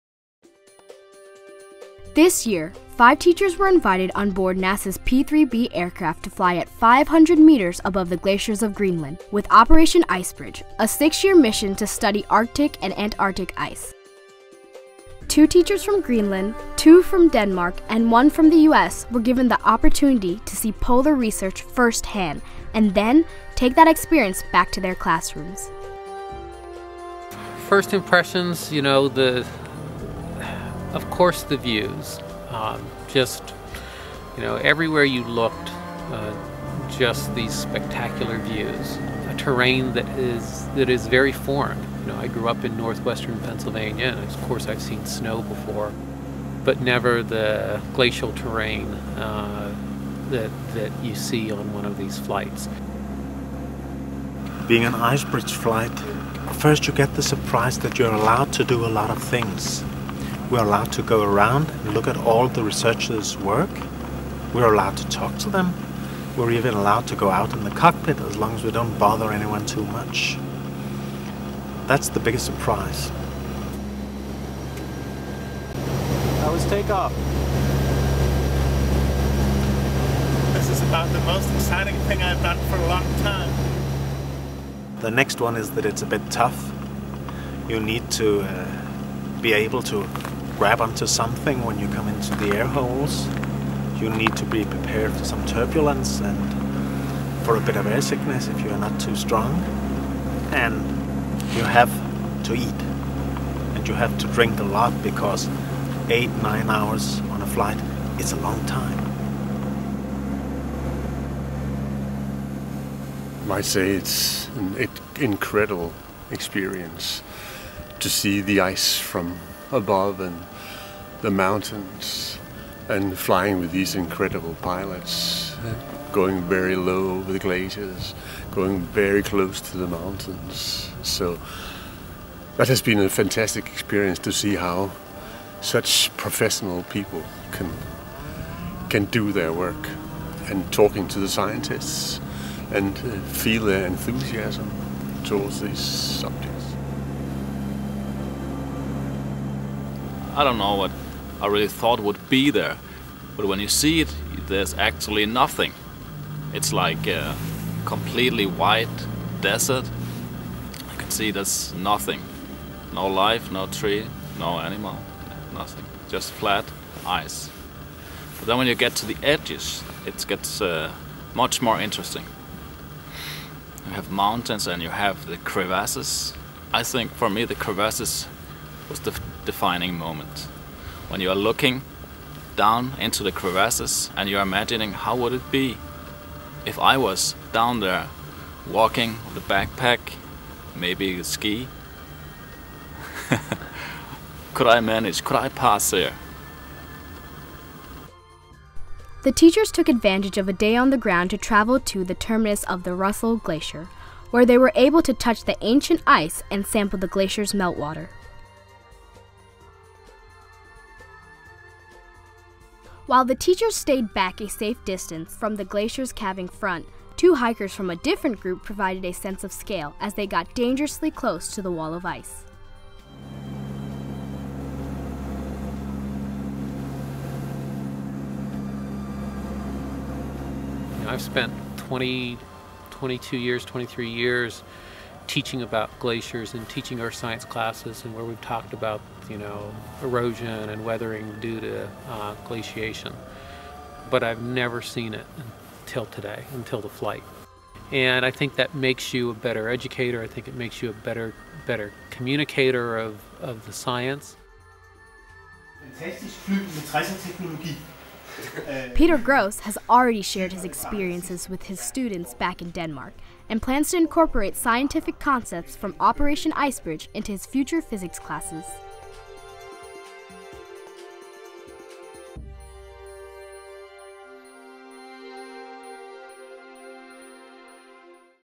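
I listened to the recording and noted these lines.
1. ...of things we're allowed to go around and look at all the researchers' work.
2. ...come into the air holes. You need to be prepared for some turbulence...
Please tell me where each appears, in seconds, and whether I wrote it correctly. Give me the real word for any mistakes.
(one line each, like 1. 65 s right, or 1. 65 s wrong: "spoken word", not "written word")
1. 59 s right
2. 91 s right.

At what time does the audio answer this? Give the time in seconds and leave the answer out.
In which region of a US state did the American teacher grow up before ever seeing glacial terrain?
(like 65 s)
42 s.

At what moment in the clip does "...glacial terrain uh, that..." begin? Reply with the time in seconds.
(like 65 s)
47 s.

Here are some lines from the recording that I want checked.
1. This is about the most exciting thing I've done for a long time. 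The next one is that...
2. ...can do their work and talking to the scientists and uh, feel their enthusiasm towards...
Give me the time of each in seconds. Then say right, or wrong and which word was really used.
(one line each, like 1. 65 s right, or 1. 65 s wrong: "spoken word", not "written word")
1. 80 s right
2. 138 s right.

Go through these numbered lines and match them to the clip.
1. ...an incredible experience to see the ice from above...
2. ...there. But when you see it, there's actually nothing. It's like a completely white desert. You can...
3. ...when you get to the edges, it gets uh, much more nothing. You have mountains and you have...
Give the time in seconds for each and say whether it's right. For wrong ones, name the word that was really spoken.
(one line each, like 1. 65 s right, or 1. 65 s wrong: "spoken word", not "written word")
1. 114 s right
2. 152 s right
3. 168 s wrong: "interesting", not "nothing".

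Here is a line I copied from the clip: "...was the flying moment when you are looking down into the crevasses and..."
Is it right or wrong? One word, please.
wrong.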